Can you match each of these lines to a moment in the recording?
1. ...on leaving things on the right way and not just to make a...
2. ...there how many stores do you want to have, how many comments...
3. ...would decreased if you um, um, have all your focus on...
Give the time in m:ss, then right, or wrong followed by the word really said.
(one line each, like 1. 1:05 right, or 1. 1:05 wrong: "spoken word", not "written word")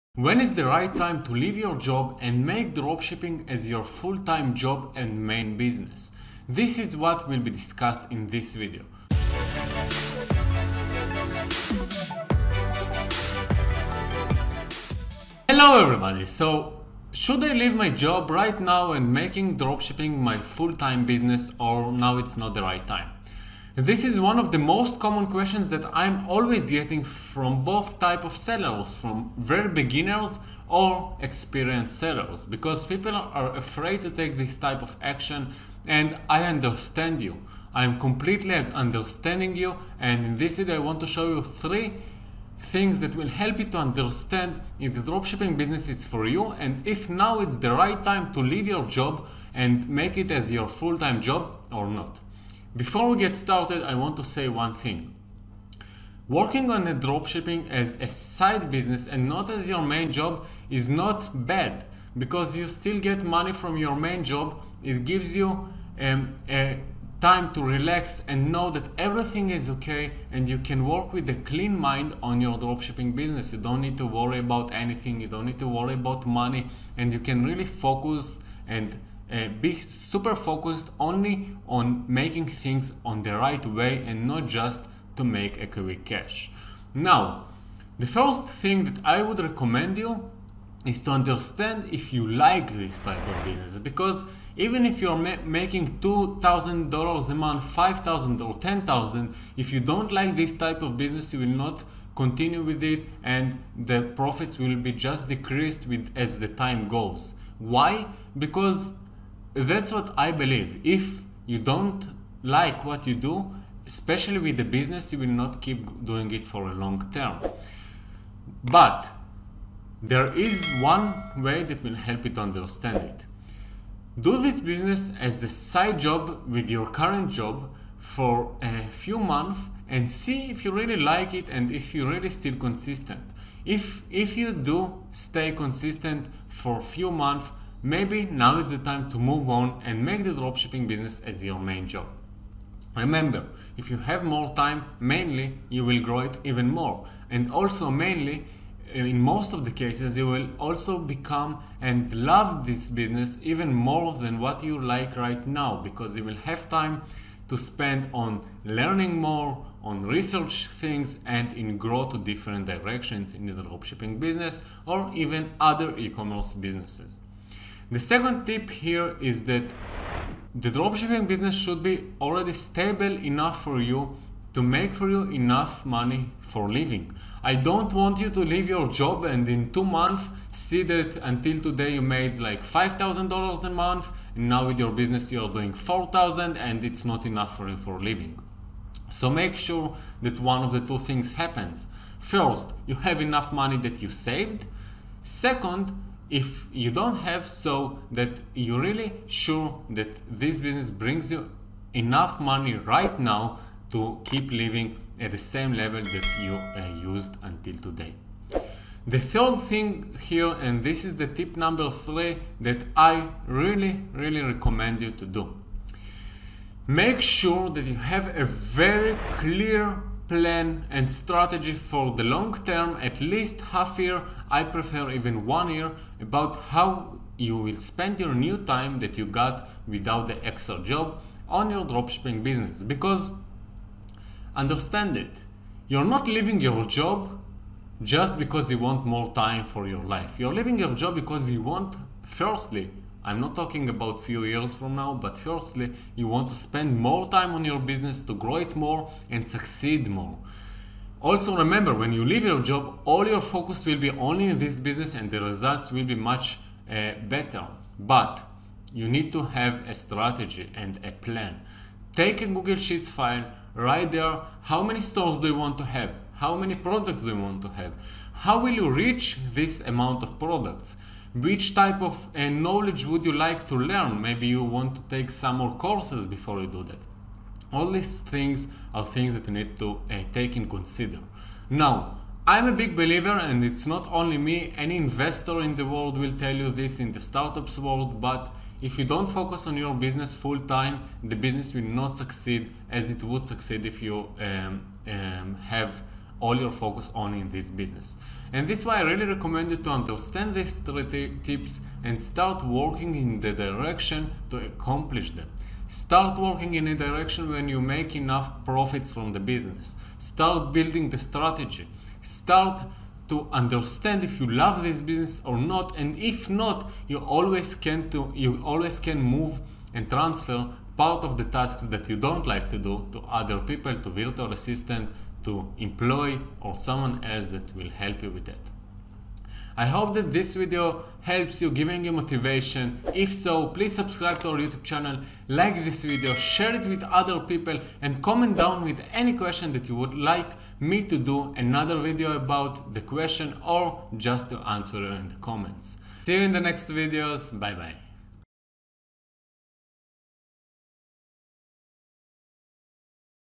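1. 1:21 wrong: "making", not "leaving"
2. 4:24 wrong: "products", not "comments"
3. 4:53 wrong: "succeed", not "decreased".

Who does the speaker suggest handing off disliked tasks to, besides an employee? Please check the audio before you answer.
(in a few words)
virtual assistant.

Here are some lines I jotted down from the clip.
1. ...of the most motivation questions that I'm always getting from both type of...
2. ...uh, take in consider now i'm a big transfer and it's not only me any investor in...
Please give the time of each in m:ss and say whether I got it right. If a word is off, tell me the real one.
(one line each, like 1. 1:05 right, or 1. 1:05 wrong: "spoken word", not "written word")
1. 0:24 wrong: "common", not "motivation"
2. 4:40 wrong: "believer", not "transfer".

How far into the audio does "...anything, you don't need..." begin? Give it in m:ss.
1:14.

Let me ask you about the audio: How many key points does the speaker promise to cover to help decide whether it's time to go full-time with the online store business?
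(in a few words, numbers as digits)
3.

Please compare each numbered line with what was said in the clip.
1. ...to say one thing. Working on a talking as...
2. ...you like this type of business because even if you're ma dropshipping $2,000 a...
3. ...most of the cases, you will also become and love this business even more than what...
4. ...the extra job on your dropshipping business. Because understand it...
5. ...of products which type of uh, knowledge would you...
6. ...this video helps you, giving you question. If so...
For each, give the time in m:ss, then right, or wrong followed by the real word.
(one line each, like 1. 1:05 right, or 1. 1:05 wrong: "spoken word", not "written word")
1. 0:54 wrong: "dropshipping", not "talking"
2. 1:32 wrong: "making", not "dropshipping"
3. 2:29 right
4. 3:50 right
5. 4:30 right
6. 5:30 wrong: "motivation", not "question".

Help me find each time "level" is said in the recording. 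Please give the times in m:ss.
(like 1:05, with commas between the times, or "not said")
3:25.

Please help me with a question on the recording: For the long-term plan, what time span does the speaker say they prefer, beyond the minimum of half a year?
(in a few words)
1 year.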